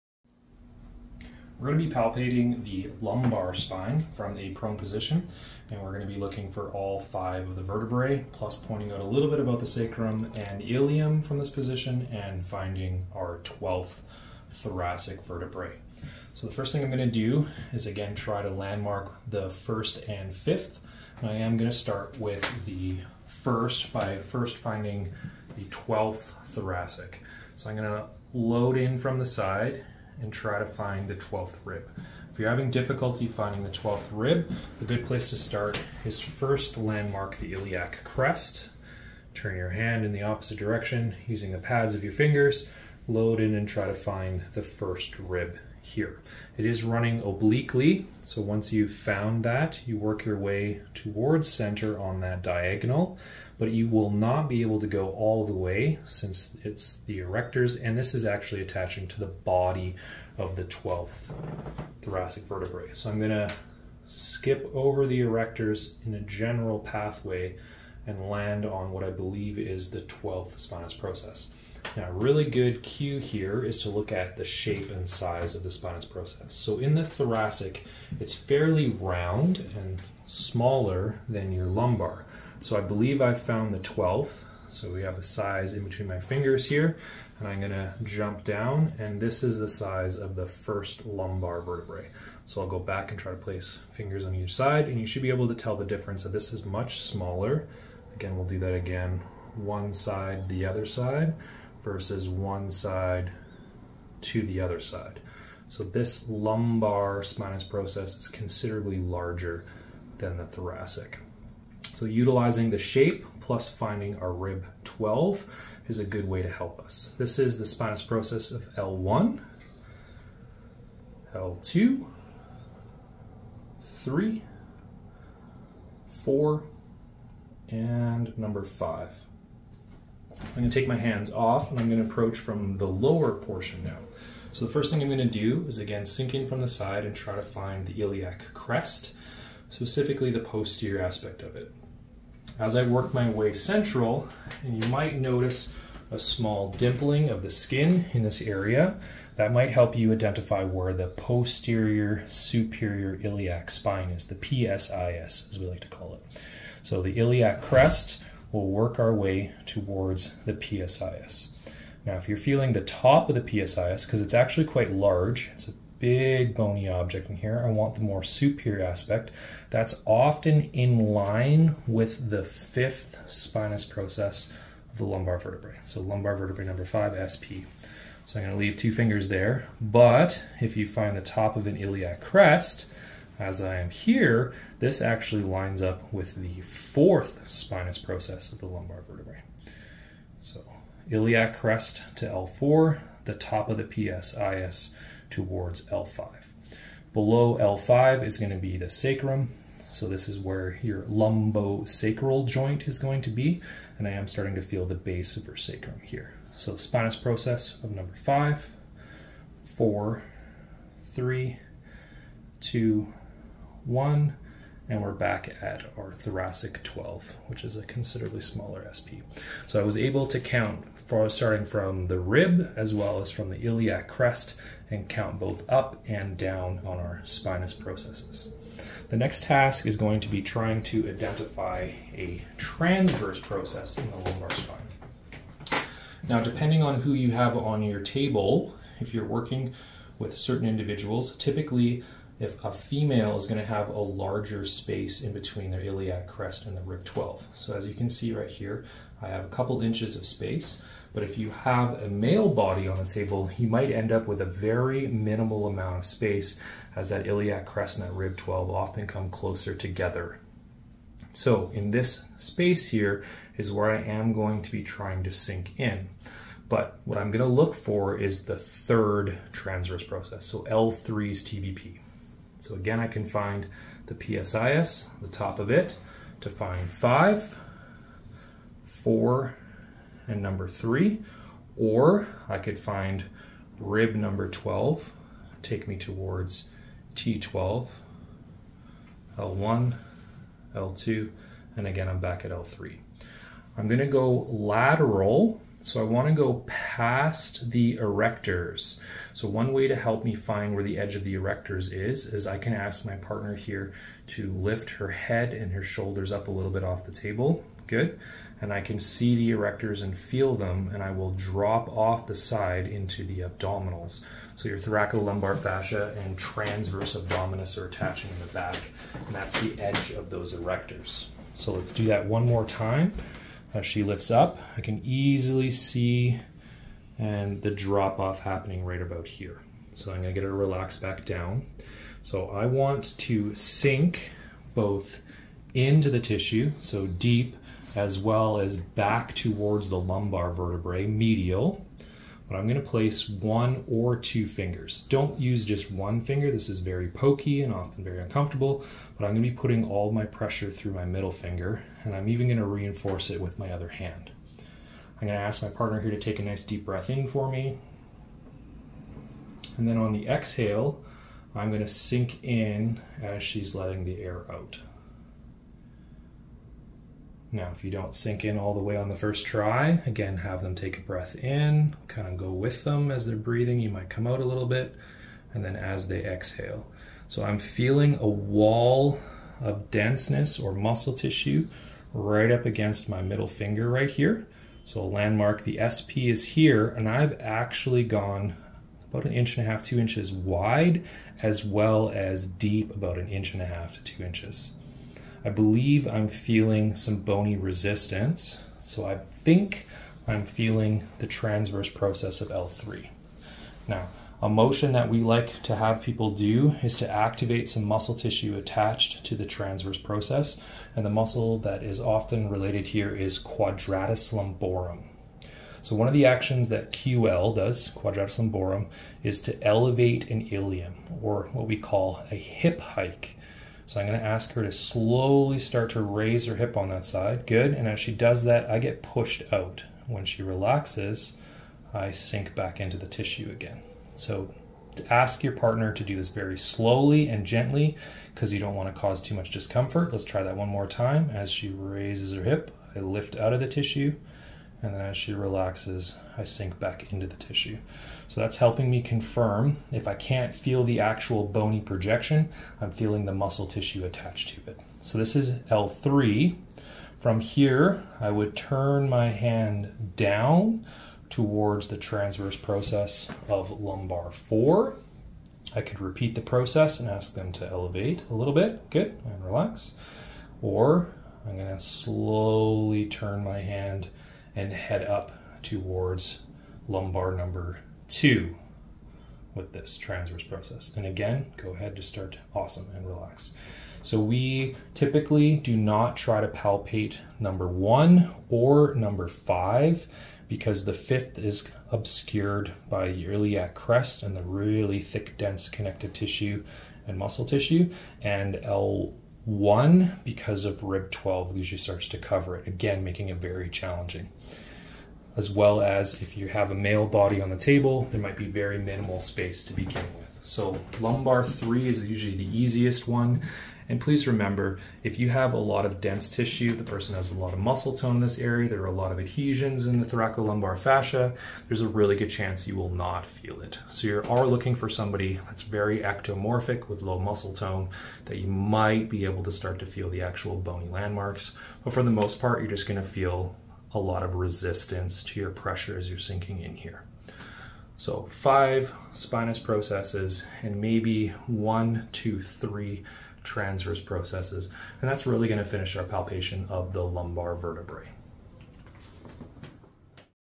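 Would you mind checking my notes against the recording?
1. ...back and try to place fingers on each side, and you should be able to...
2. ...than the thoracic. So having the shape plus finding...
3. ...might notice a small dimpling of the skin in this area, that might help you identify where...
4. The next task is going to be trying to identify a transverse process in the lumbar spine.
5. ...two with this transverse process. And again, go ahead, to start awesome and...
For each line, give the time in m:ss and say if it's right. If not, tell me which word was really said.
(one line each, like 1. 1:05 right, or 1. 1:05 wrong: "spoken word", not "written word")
1. 1:32 right
2. 1:50 wrong: "utilizing", not "having"
3. 2:24 right
4. 3:49 right
5. 7:58 right.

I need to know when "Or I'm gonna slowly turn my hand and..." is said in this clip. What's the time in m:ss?
7:50.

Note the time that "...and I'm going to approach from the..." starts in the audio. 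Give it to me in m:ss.
2:11.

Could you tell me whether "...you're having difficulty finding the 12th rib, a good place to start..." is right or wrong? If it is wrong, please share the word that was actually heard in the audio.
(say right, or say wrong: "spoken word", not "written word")
right.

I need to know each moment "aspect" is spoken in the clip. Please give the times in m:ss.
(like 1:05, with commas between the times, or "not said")
2:21, 2:48.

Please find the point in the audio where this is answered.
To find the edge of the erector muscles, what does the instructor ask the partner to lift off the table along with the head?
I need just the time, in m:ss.
5:05.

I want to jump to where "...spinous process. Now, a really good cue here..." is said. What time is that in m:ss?
1:10.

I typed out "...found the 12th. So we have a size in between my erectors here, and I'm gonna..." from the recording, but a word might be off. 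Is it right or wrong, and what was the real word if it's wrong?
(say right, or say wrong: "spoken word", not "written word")
wrong: "fingers", not "erectors".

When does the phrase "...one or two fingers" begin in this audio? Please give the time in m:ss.
5:43.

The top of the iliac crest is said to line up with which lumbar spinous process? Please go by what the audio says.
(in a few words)
fourth.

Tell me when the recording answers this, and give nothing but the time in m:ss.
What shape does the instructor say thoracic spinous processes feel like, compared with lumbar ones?
1:18.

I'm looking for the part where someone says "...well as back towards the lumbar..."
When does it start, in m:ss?
5:38.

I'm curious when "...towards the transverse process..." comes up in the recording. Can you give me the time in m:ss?
7:41.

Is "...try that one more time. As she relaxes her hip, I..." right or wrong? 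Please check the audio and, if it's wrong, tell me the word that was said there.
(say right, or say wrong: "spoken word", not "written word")
wrong: "raises", not "relaxes".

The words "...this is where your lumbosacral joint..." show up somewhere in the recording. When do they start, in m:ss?
3:20.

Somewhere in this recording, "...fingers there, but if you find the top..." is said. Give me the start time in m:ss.
2:58.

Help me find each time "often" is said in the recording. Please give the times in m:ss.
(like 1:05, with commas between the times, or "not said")
2:50, 4:18, 5:47, 6:51.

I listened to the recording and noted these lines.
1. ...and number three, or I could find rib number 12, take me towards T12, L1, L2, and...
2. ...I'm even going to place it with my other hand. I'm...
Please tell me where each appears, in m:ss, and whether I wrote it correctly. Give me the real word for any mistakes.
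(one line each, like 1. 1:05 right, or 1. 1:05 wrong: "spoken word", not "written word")
1. 4:40 right
2. 5:52 wrong: "reinforce", not "place".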